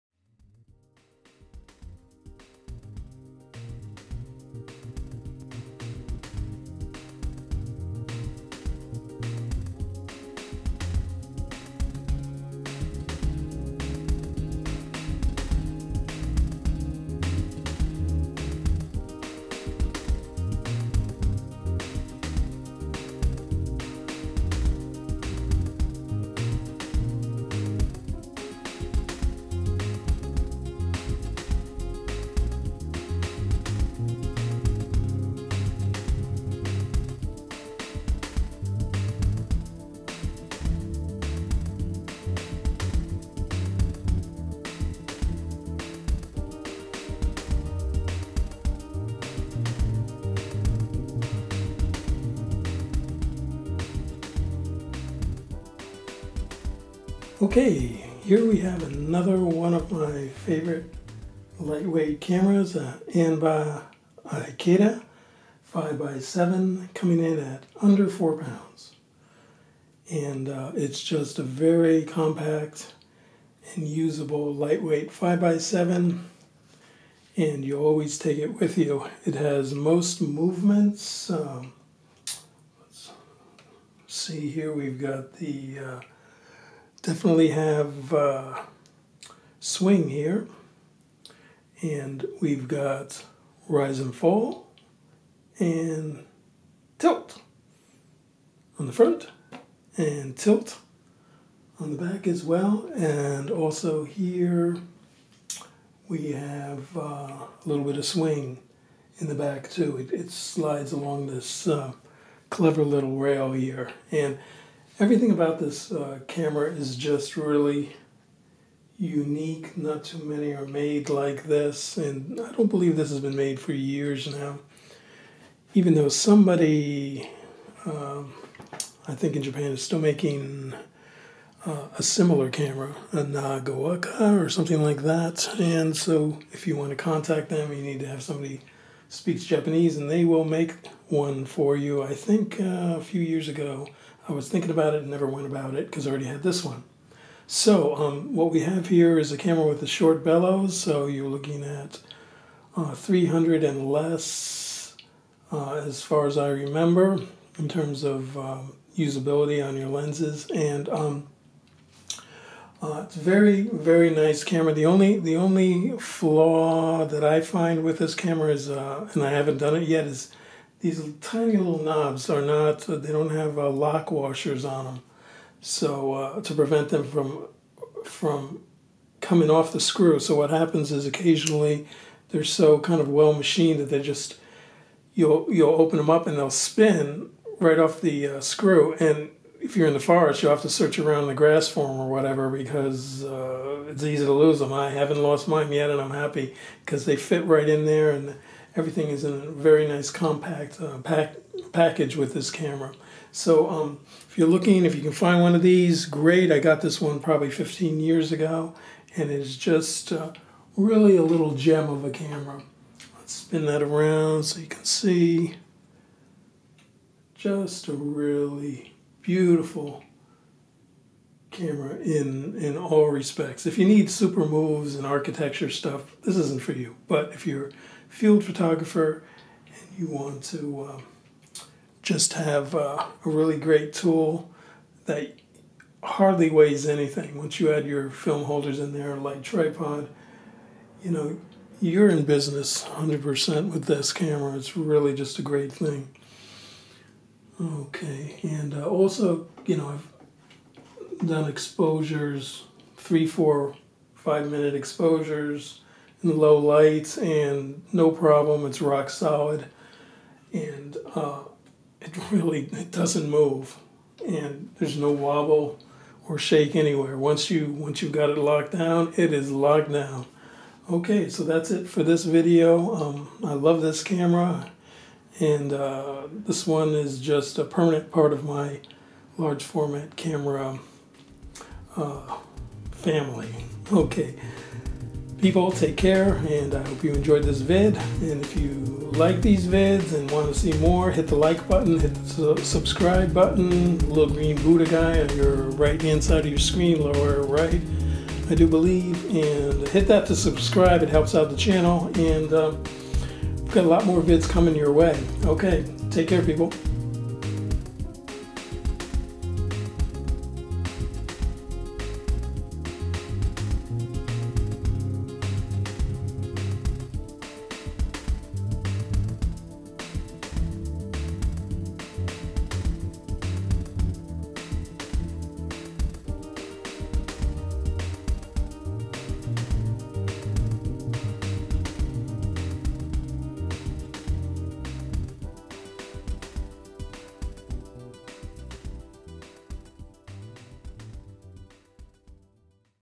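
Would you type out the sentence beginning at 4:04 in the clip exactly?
It's really just a great thing.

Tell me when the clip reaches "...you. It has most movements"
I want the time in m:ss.
1:18.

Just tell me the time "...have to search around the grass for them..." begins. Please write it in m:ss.
3:10.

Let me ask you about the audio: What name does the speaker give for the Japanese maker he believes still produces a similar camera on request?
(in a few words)
Nagawaka.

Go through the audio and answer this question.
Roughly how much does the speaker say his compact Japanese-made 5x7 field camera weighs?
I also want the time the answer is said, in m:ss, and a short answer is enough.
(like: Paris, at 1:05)
under 4 pounds, at 1:07.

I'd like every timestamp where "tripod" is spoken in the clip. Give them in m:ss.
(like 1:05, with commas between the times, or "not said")
3:59.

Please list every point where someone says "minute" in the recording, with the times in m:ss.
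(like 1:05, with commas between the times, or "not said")
4:14.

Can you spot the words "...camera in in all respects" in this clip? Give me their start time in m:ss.
3:41.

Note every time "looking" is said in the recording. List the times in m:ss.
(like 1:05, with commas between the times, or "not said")
2:31, 3:24.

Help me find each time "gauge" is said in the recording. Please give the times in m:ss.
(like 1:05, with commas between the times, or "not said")
not said.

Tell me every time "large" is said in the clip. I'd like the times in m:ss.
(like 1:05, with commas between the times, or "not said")
4:39.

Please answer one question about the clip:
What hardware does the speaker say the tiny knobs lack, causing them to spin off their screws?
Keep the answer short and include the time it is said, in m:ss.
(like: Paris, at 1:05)
lock washers, at 2:53.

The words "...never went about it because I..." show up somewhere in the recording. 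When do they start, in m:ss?
2:25.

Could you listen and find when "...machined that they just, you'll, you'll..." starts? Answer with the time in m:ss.
3:03.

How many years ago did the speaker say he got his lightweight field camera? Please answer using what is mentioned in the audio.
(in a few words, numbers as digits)
15 years.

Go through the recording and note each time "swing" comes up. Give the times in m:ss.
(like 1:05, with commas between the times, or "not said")
1:29, 1:48.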